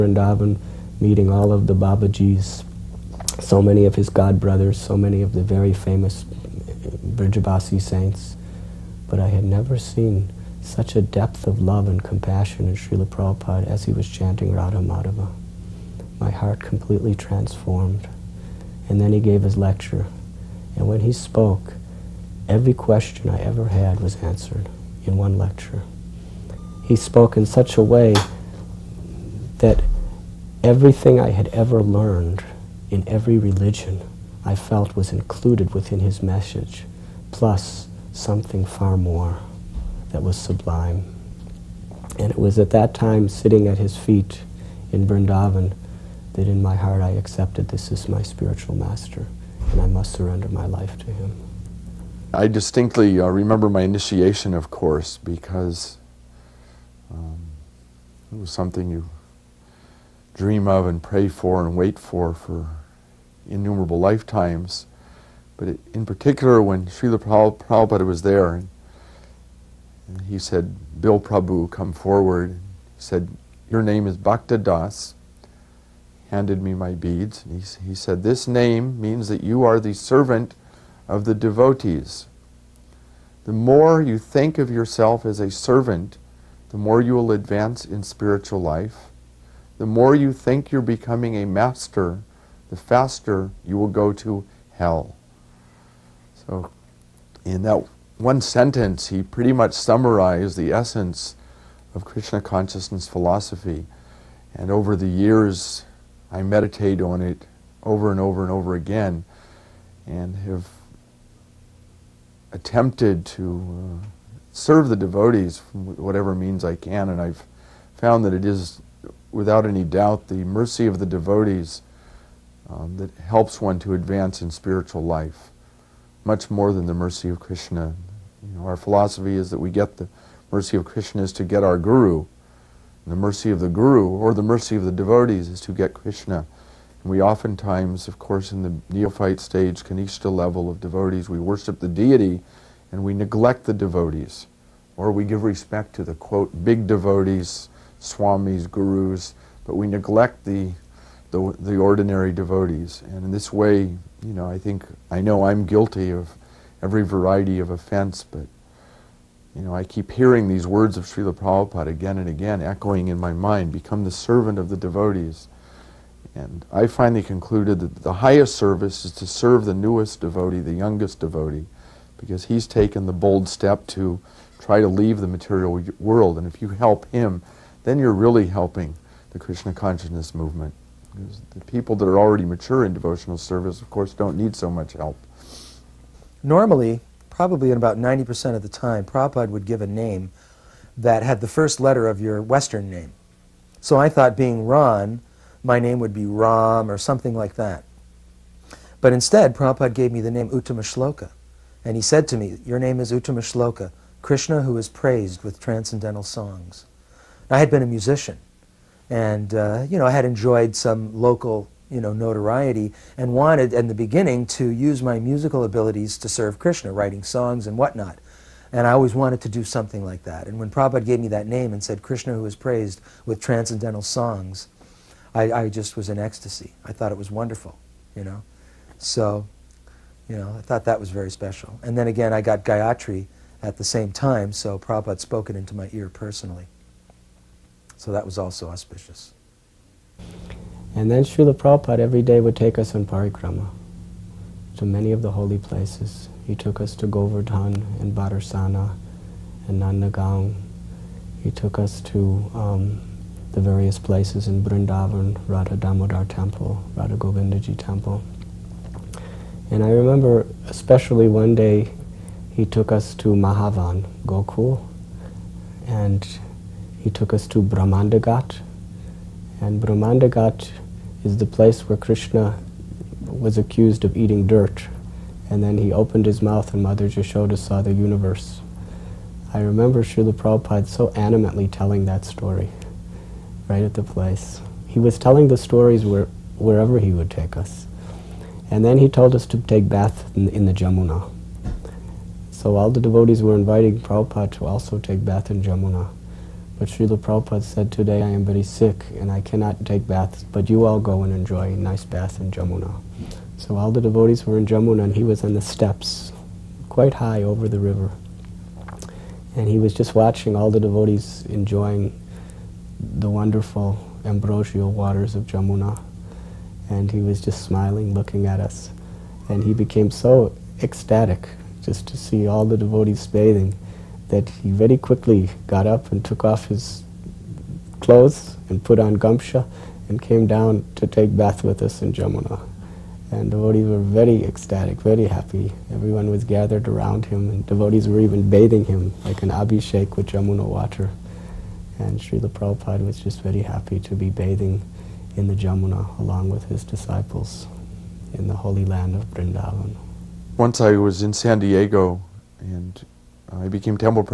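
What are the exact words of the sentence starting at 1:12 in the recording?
He said, Your name is Bhakta Das.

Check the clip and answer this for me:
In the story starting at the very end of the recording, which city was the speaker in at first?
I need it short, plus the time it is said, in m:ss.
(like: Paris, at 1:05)
San Diego, at 5:51.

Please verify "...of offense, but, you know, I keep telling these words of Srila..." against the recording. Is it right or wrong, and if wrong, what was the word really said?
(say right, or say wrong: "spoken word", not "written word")
wrong: "hearing", not "telling".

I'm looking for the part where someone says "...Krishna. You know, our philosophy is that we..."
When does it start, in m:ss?
2:07.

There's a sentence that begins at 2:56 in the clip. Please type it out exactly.
And if you help him, then you're really helping the Krishna consciousness movement.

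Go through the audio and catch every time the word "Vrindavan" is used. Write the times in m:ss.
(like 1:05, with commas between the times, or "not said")
0:45, 5:49.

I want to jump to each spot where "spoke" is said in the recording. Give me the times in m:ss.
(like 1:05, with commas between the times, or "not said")
0:21, 0:26, 3:55.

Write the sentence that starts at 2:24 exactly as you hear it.
Or we give respect to the, quote, big devotees, swamis, gurus, but we neglect the the, the ordinary devotees.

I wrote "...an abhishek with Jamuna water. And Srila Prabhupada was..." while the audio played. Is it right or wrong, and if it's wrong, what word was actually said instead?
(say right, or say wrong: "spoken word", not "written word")
right.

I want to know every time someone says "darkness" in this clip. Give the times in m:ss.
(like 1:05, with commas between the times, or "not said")
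not said.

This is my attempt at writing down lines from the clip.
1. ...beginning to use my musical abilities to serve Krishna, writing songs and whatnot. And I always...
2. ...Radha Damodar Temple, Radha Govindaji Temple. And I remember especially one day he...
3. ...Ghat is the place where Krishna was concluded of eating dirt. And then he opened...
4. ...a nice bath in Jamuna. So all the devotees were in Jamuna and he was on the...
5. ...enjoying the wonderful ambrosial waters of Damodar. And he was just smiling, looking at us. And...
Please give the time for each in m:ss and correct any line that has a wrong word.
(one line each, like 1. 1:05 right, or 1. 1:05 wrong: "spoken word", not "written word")
1. 3:33 right
2. 4:15 right
3. 4:30 wrong: "accused", not "concluded"
4. 5:01 right
5. 5:11 wrong: "Jamuna", not "Damodar".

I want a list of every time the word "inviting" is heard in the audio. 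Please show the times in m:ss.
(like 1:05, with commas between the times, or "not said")
4:53.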